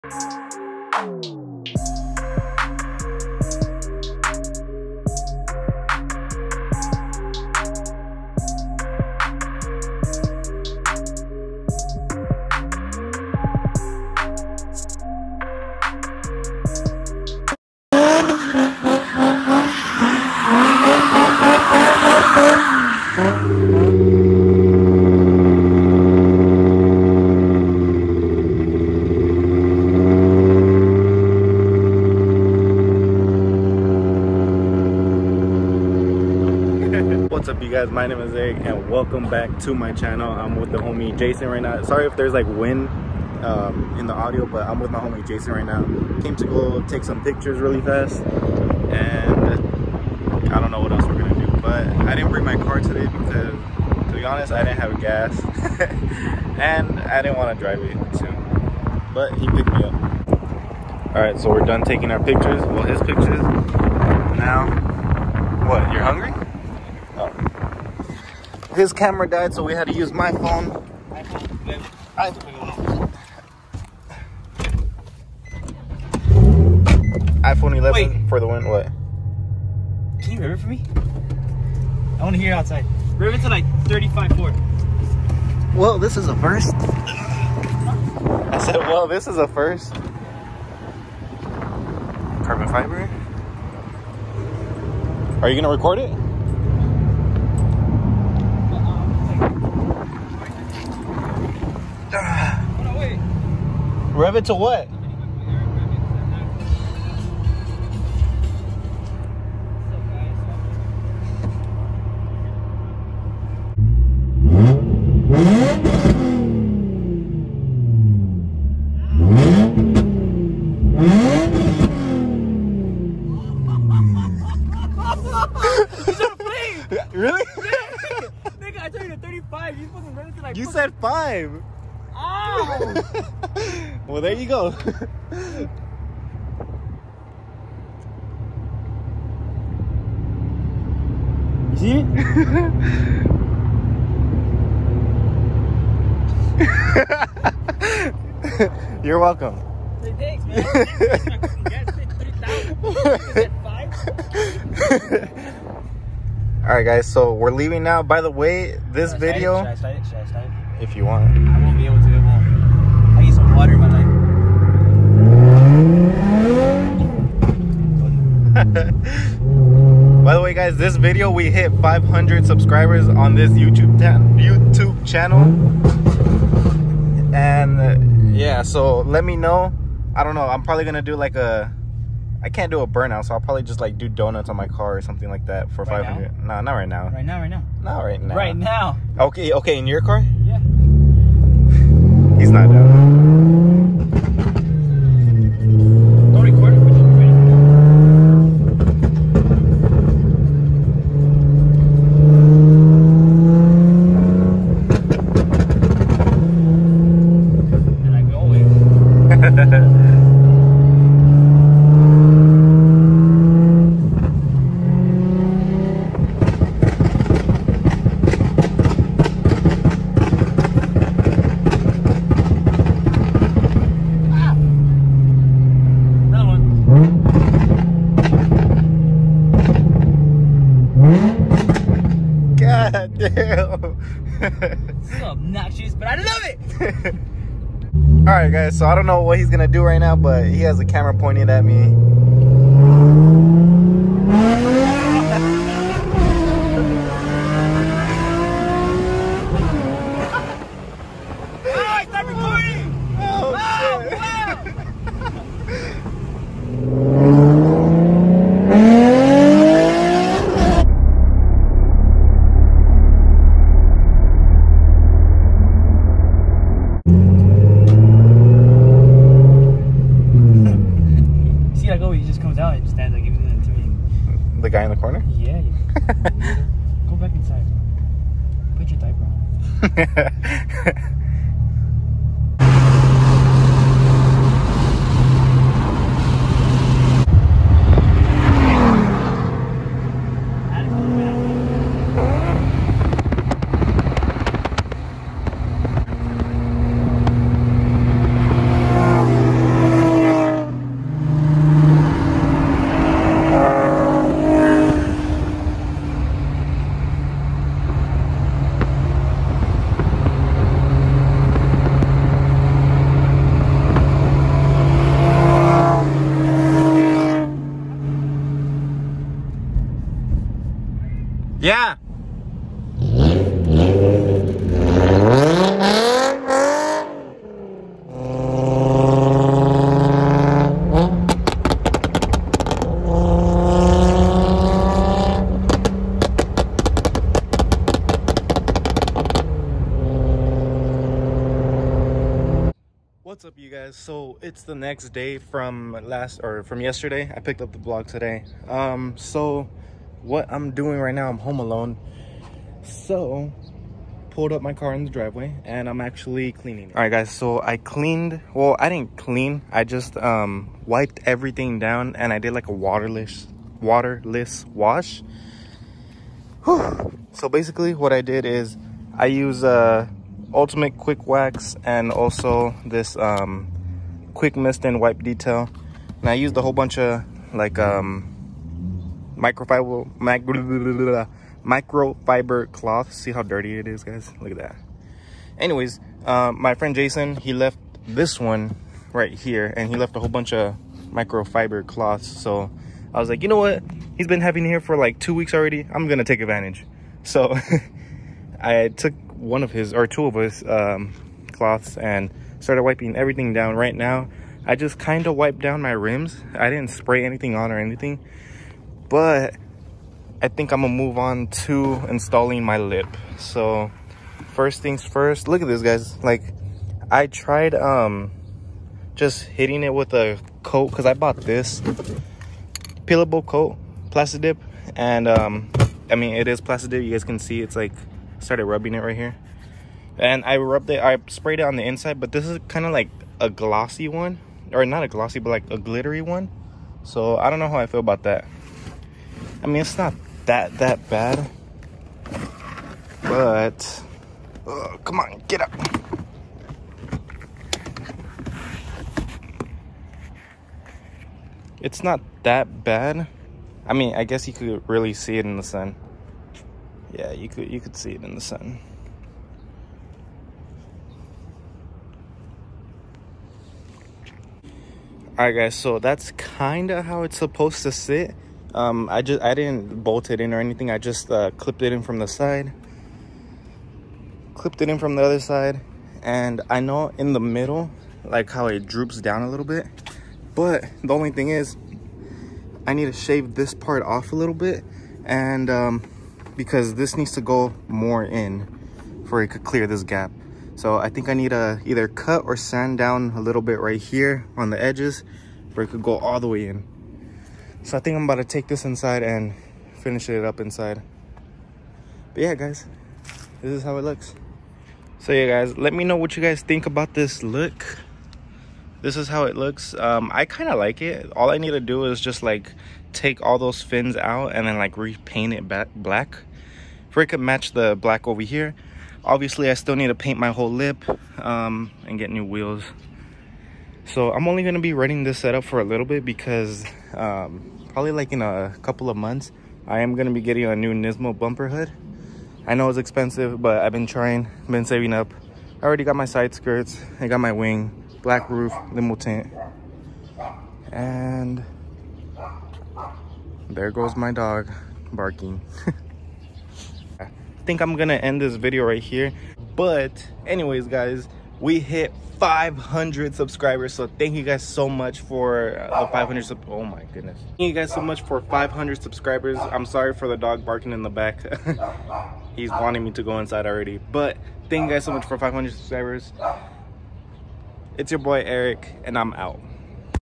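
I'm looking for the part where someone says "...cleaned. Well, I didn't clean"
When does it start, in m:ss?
5:57.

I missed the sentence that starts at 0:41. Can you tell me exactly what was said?
Sorry if there's like wind um, in the audio, but I'm with my homie Jason right now.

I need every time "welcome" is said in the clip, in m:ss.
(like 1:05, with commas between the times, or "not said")
0:38, 2:29.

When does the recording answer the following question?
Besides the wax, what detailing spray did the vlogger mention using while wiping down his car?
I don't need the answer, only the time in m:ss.
6:14.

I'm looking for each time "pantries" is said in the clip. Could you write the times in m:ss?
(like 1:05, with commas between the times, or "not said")
not said.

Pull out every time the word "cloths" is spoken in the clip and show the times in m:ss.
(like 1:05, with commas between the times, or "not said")
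6:22, 6:31, 6:41.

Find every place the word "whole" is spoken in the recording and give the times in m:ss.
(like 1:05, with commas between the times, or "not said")
6:16, 6:30, 8:40.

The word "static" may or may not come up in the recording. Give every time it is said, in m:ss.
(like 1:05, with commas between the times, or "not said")
not said.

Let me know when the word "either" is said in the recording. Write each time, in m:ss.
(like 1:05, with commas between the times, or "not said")
8:11.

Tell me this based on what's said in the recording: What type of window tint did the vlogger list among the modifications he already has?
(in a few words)
Limo tint.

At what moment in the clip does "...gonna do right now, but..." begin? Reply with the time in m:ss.
3:59.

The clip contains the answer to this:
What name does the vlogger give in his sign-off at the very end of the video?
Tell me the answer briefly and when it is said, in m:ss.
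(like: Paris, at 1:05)
Eric, at 9:28.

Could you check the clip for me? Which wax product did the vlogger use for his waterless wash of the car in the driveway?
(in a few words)
Ultimate Quick Wax.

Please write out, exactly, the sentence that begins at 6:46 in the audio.
I didn't spray anything on or anything but I think I'm gonna move on to installing my lip.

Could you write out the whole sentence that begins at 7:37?
Yeah, you could you could see it in the sun.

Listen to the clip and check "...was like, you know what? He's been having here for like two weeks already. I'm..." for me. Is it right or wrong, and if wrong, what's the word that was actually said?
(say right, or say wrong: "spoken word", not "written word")
right.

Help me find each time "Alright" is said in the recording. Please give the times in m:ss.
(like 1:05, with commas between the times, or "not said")
1:01, 7:45.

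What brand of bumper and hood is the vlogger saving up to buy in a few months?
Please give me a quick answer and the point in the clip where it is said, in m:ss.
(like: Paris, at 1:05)
Nismo, at 8:50.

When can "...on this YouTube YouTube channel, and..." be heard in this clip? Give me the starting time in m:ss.
2:53.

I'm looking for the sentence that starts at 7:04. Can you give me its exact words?
And um, I mean, it is plastic dip.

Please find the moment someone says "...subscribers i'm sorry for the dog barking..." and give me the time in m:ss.
9:18.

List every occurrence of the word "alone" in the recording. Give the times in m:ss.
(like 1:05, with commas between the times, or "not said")
5:51.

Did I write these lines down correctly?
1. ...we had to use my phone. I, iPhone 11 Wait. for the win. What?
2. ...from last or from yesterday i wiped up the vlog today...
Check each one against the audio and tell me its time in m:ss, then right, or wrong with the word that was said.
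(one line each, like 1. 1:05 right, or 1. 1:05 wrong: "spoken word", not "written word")
1. 1:09 right
2. 5:45 wrong: "picked", not "wiped".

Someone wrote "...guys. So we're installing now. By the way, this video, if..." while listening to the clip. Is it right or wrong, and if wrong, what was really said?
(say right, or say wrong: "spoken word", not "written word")
wrong: "leaving", not "installing".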